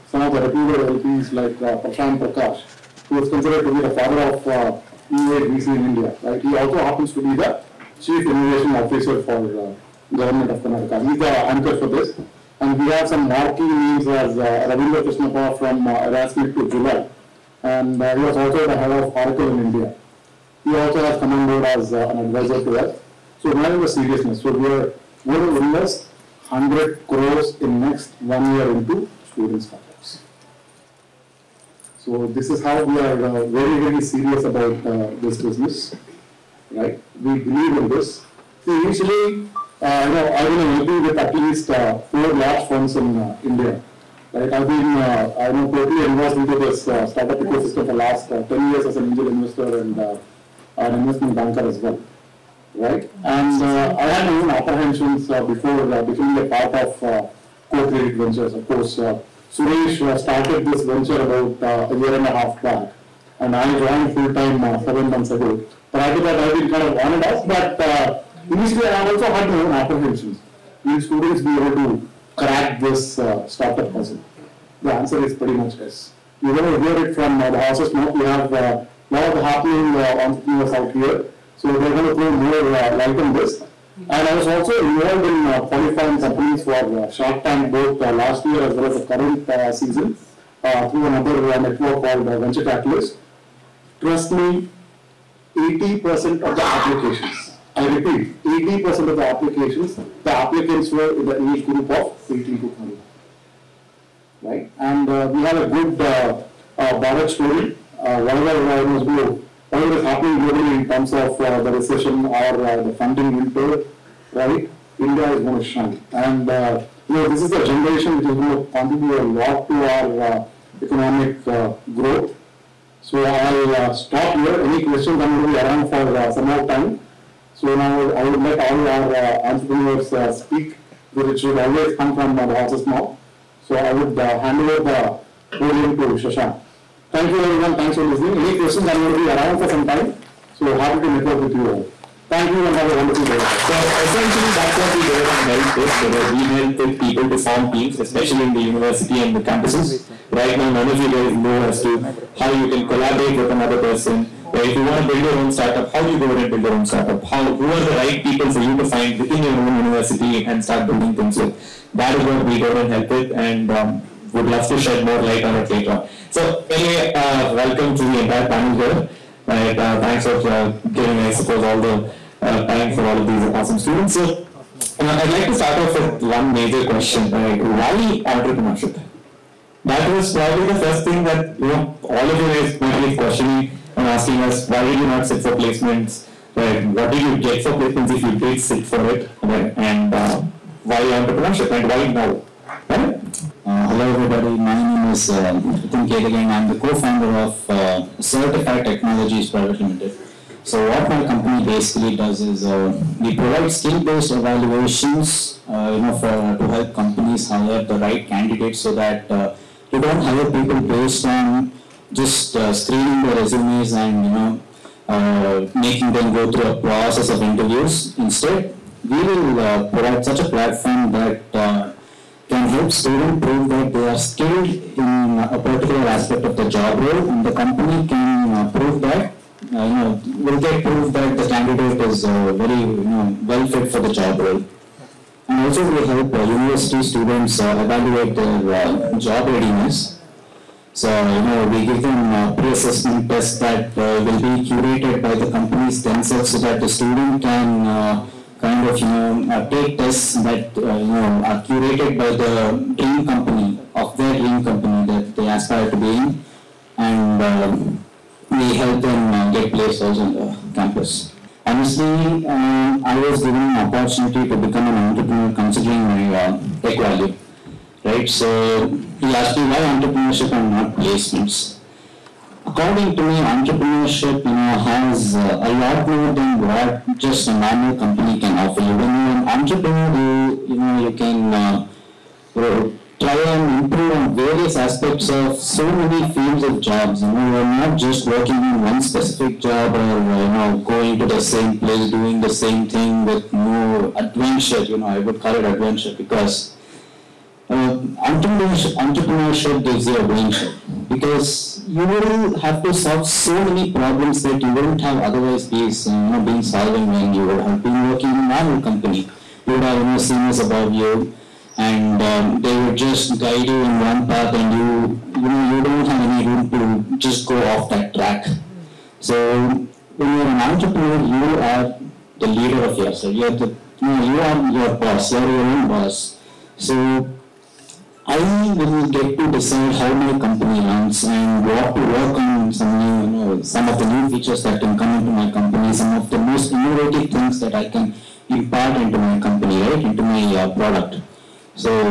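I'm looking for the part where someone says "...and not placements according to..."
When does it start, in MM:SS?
04:30.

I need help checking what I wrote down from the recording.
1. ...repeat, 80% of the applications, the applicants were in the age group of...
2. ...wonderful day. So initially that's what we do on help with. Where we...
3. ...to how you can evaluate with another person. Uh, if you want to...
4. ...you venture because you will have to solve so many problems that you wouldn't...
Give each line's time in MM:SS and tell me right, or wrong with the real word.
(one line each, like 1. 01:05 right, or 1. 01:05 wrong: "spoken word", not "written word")
1. 01:37 right
2. 02:23 wrong: "essentially", not "initially"
3. 02:31 wrong: "collaborate", not "evaluate"
4. 05:00 wrong: "adventure", not "venture".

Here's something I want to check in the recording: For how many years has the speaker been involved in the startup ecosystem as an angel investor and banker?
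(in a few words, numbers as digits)
10 years.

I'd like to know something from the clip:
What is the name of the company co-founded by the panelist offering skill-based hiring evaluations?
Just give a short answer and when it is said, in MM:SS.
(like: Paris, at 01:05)
Certified Technologies Private Limited, at 03:18.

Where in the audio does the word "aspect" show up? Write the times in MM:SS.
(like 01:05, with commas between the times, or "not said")
03:46, 04:44.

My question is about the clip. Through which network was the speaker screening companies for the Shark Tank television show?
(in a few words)
Venture Catalyst.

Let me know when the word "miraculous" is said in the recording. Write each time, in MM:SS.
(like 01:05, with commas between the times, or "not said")
not said.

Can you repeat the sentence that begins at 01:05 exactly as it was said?
Prior to that, I've been kind of on and off, but initially I also had my own apprehensions.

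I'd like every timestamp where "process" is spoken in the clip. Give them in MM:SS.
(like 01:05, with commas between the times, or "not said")
03:36.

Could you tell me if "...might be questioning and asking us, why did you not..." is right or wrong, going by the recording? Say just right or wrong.
right.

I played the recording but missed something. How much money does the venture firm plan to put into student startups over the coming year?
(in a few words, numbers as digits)
100 crores.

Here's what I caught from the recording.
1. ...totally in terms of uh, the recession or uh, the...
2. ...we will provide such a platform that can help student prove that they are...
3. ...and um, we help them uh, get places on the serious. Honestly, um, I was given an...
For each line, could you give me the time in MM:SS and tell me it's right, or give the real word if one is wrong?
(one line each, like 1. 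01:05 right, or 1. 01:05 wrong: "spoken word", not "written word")
1. 01:50 wrong: "globally", not "totally"
2. 03:39 right
3. 04:17 wrong: "campus", not "serious".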